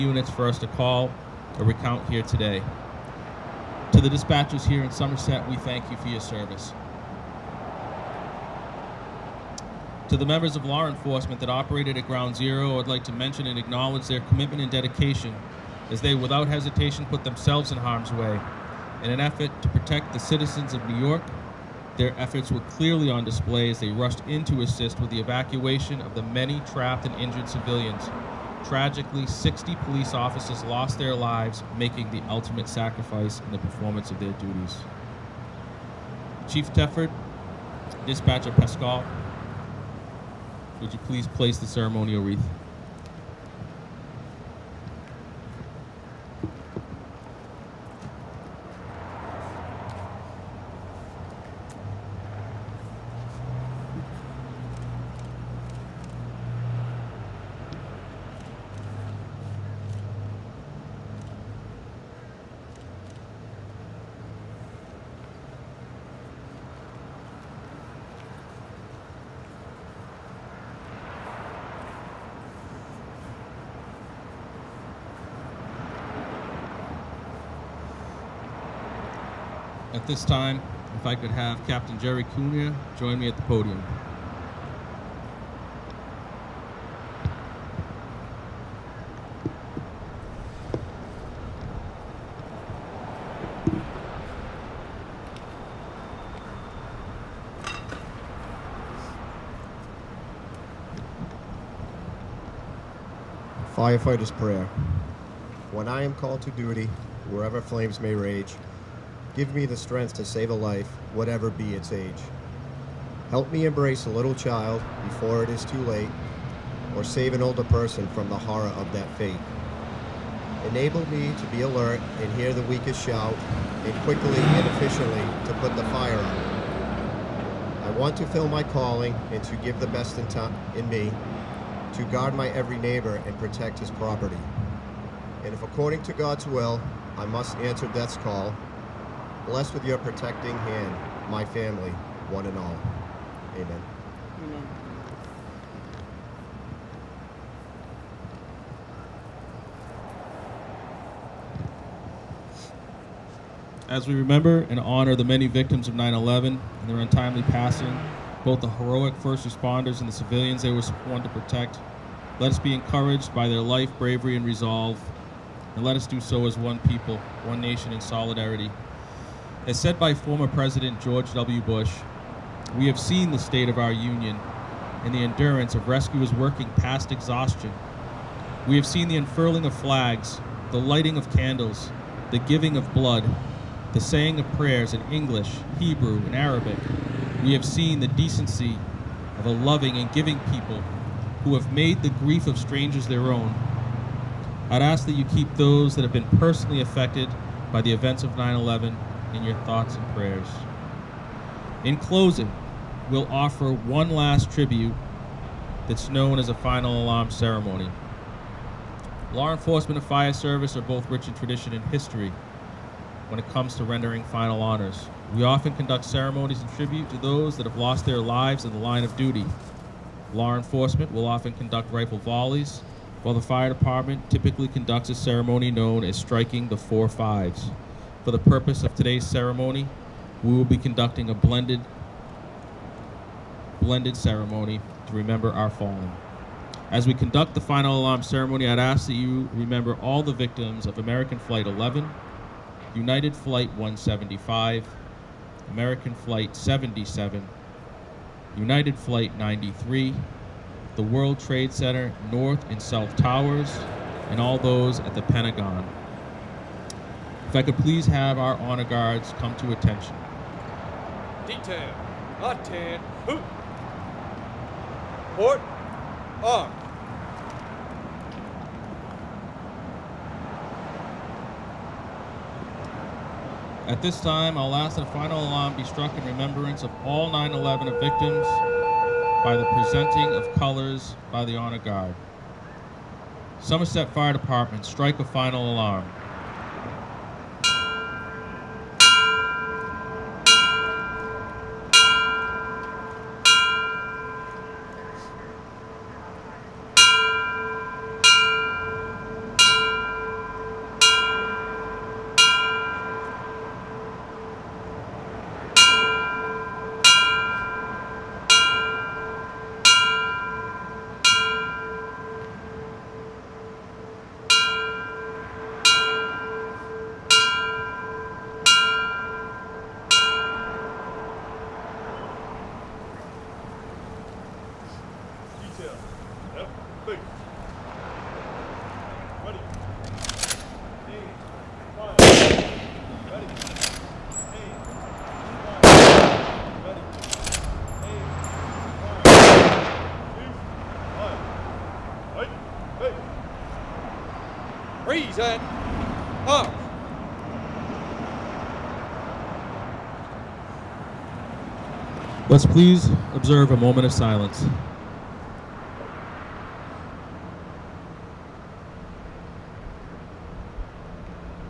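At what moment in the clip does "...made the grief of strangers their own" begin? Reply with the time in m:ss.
3:11.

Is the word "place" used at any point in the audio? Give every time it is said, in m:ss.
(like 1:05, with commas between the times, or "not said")
0:41.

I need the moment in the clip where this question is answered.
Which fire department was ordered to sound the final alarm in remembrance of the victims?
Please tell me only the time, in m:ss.
4:43.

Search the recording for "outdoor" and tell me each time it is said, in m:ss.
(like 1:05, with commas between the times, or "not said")
not said.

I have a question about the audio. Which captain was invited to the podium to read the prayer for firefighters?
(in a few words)
Jerry Cunha.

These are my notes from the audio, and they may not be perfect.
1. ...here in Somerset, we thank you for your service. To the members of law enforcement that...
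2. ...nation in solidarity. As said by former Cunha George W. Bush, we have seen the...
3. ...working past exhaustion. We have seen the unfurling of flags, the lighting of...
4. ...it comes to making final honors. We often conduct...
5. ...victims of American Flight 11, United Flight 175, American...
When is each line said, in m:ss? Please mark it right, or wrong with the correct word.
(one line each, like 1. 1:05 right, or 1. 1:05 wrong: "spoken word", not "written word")
1. 0:04 right
2. 2:47 wrong: "President", not "Cunha"
3. 2:56 right
4. 3:33 wrong: "rendering", not "making"
5. 4:00 right.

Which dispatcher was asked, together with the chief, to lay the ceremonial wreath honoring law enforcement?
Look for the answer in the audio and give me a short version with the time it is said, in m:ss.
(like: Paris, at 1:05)
Pascal, at 0:38.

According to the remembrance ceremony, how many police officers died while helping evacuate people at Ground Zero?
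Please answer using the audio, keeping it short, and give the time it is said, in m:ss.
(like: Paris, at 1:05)
60, at 0:29.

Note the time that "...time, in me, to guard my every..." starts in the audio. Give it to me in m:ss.
2:10.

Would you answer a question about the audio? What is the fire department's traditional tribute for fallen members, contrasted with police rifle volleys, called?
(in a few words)
Striking the four fives.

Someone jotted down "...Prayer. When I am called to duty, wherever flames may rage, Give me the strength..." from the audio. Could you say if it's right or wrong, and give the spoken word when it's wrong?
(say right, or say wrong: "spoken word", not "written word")
right.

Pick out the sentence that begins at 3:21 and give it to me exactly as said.
In closing, we'll offer one last tribute that's known as a final alarm ceremony.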